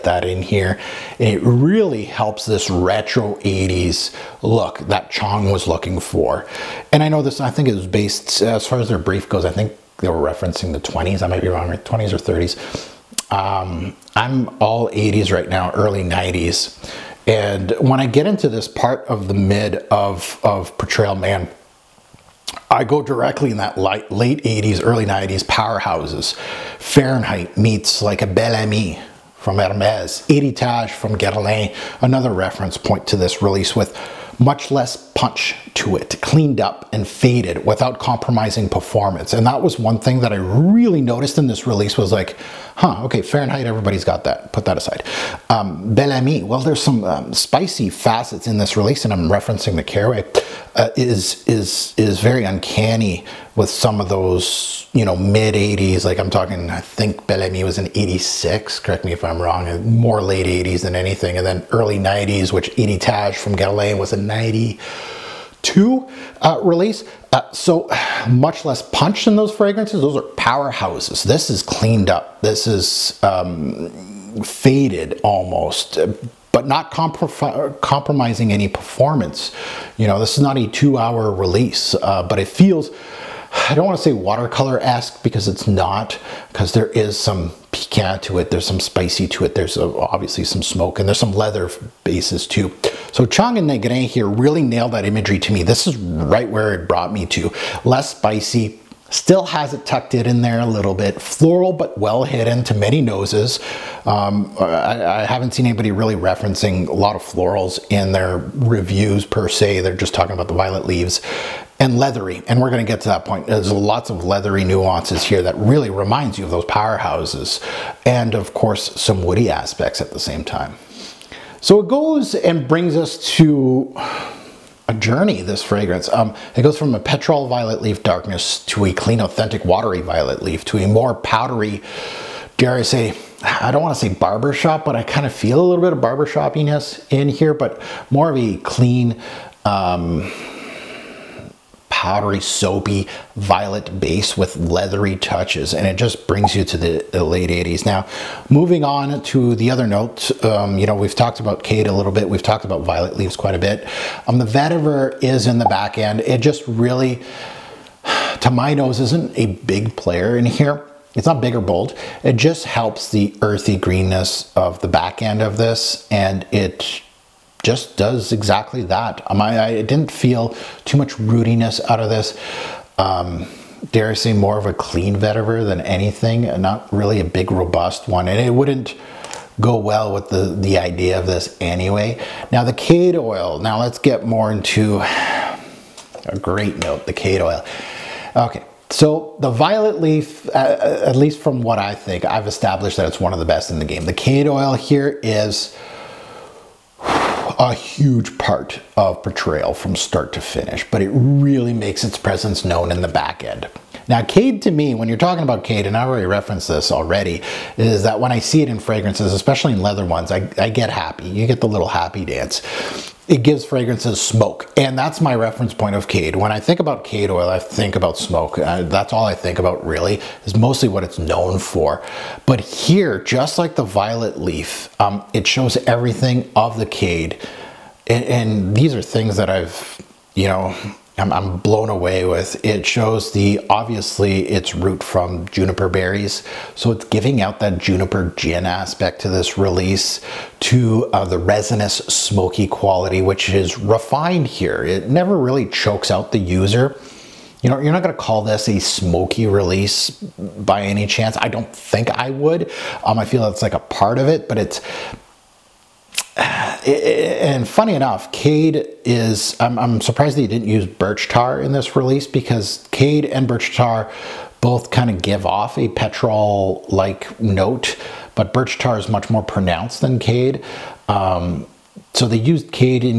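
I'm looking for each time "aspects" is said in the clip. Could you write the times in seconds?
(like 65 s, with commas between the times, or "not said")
119 s, 238 s.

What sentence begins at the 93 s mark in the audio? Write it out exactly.
So Chong and Negrin here really nailed that imagery to me.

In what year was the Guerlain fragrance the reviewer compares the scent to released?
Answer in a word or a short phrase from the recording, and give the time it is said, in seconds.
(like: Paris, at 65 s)
1992, at 64 s.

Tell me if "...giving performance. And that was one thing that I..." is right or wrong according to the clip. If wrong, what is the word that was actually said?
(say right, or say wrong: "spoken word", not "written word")
wrong: "compromising", not "giving".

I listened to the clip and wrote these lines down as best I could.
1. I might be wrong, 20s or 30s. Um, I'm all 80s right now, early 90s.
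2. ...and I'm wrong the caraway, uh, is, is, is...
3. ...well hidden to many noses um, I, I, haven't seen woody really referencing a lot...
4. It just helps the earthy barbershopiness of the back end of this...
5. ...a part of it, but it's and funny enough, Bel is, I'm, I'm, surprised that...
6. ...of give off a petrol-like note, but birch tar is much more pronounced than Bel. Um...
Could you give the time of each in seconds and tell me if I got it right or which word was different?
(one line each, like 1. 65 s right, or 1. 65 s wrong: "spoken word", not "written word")
1. 11 s right
2. 49 s wrong: "referencing", not "wrong"
3. 101 s wrong: "anybody", not "woody"
4. 162 s wrong: "greenness", not "barbershopiness"
5. 253 s wrong: "Cade", not "Bel"
6. 265 s wrong: "Cade", not "Bel".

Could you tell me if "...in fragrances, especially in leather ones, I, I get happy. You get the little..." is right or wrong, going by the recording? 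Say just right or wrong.
right.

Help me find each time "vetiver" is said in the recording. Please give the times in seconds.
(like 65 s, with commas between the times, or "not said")
154 s, 175 s.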